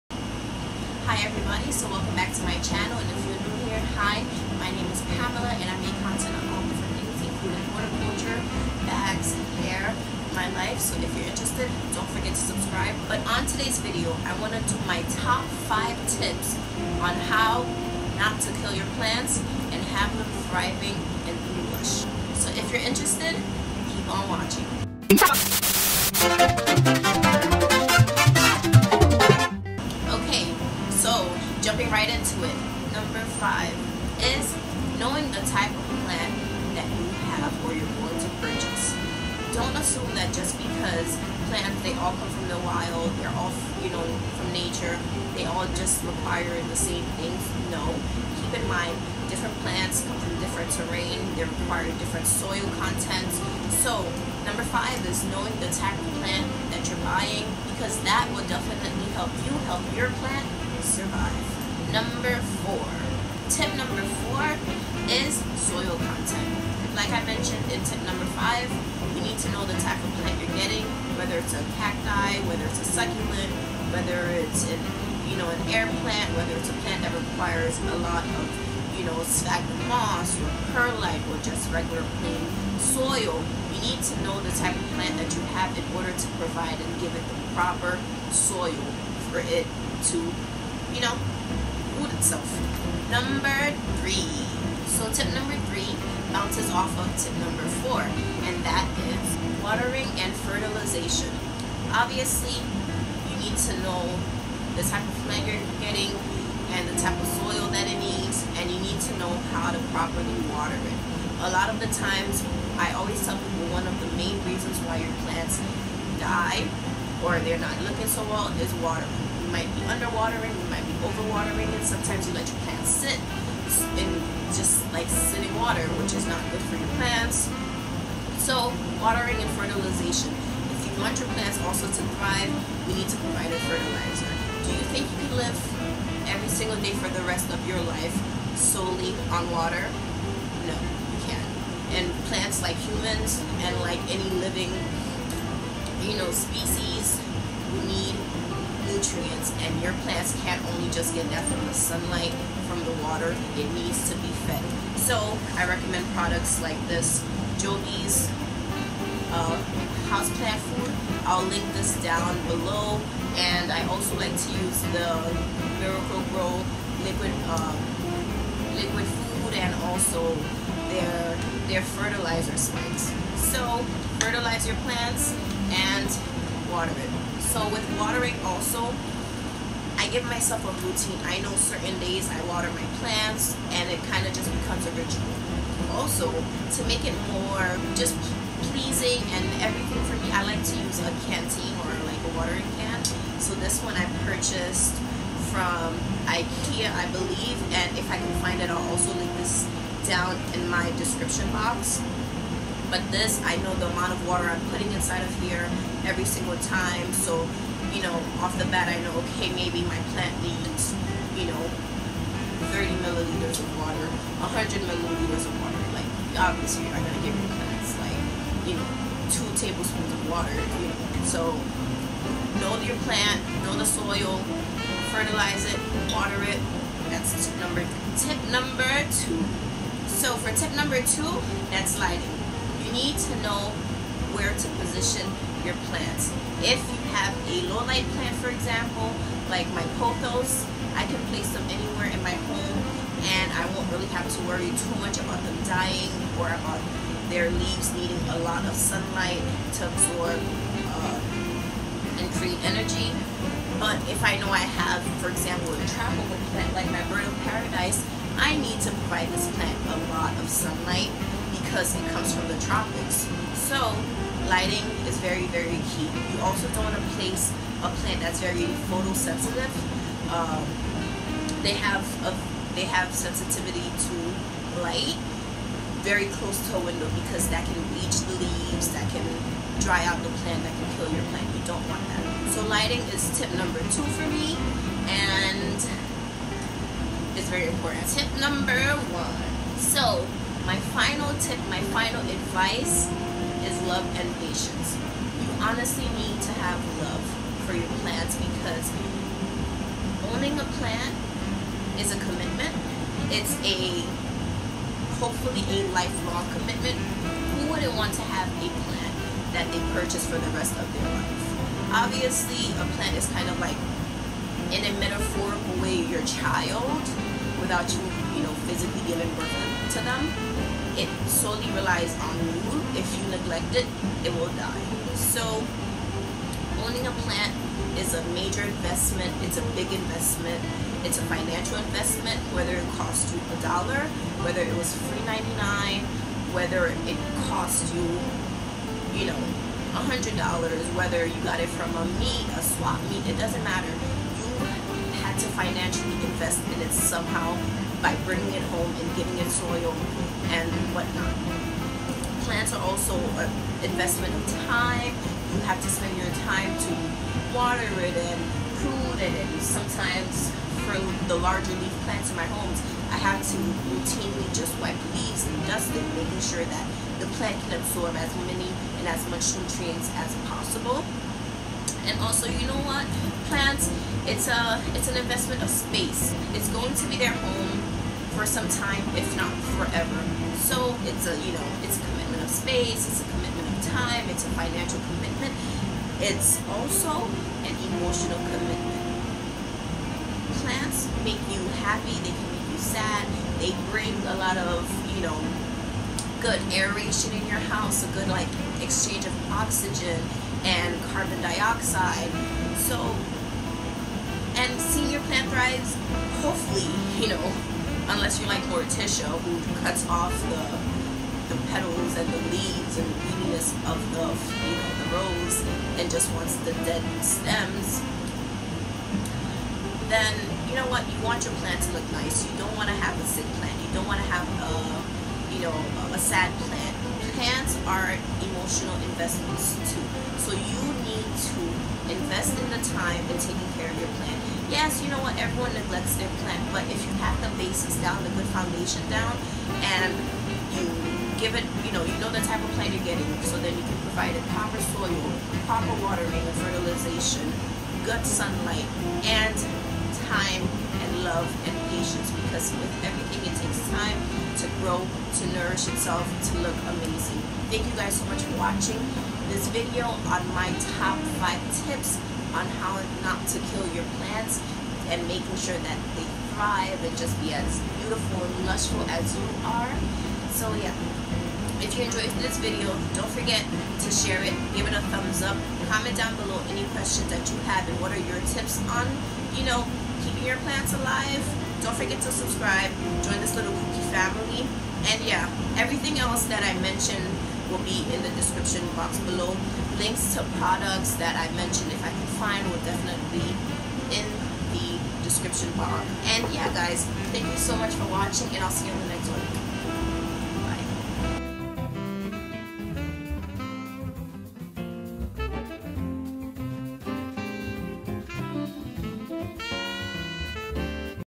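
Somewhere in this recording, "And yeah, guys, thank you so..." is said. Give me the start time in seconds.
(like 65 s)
496 s.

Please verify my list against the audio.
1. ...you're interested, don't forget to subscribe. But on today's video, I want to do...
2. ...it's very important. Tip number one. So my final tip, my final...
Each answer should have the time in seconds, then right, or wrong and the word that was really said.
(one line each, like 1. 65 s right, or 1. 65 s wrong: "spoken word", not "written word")
1. 11 s right
2. 287 s right.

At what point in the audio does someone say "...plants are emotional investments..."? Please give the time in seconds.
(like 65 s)
427 s.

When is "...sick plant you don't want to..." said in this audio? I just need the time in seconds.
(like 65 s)
423 s.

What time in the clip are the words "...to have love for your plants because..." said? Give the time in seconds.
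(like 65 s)
296 s.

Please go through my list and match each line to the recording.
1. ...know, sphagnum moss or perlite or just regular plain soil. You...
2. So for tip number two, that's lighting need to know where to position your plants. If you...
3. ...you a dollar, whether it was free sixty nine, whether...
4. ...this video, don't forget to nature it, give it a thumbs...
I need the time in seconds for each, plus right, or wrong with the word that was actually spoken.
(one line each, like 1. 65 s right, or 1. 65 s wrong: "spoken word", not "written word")
1. 79 s right
2. 230 s right
3. 333 s wrong: "ninety", not "sixty"
4. 472 s wrong: "share", not "nature".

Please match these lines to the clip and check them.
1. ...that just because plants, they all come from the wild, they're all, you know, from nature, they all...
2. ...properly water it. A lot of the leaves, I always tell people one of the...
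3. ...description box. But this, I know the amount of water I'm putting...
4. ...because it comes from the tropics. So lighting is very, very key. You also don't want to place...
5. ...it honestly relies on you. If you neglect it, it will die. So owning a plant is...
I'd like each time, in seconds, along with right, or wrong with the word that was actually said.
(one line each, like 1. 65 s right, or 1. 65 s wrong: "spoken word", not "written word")
1. 40 s right
2. 109 s wrong: "times", not "leaves"
3. 200 s right
4. 261 s right
5. 320 s wrong: "solely", not "honestly".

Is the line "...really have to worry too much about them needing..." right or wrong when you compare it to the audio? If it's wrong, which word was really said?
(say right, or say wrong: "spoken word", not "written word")
wrong: "dying", not "needing".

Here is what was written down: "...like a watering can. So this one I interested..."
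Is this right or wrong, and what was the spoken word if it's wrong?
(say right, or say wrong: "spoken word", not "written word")
wrong: "purchased", not "interested".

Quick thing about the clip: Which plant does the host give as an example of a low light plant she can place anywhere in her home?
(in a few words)
pothos.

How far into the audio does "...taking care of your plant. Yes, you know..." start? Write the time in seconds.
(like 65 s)
433 s.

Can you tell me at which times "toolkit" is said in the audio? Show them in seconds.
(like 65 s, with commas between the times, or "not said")
not said.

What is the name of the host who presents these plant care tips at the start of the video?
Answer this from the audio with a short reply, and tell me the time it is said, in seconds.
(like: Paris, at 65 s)
Pamella, at 5 s.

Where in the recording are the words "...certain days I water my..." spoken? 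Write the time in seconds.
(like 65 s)
181 s.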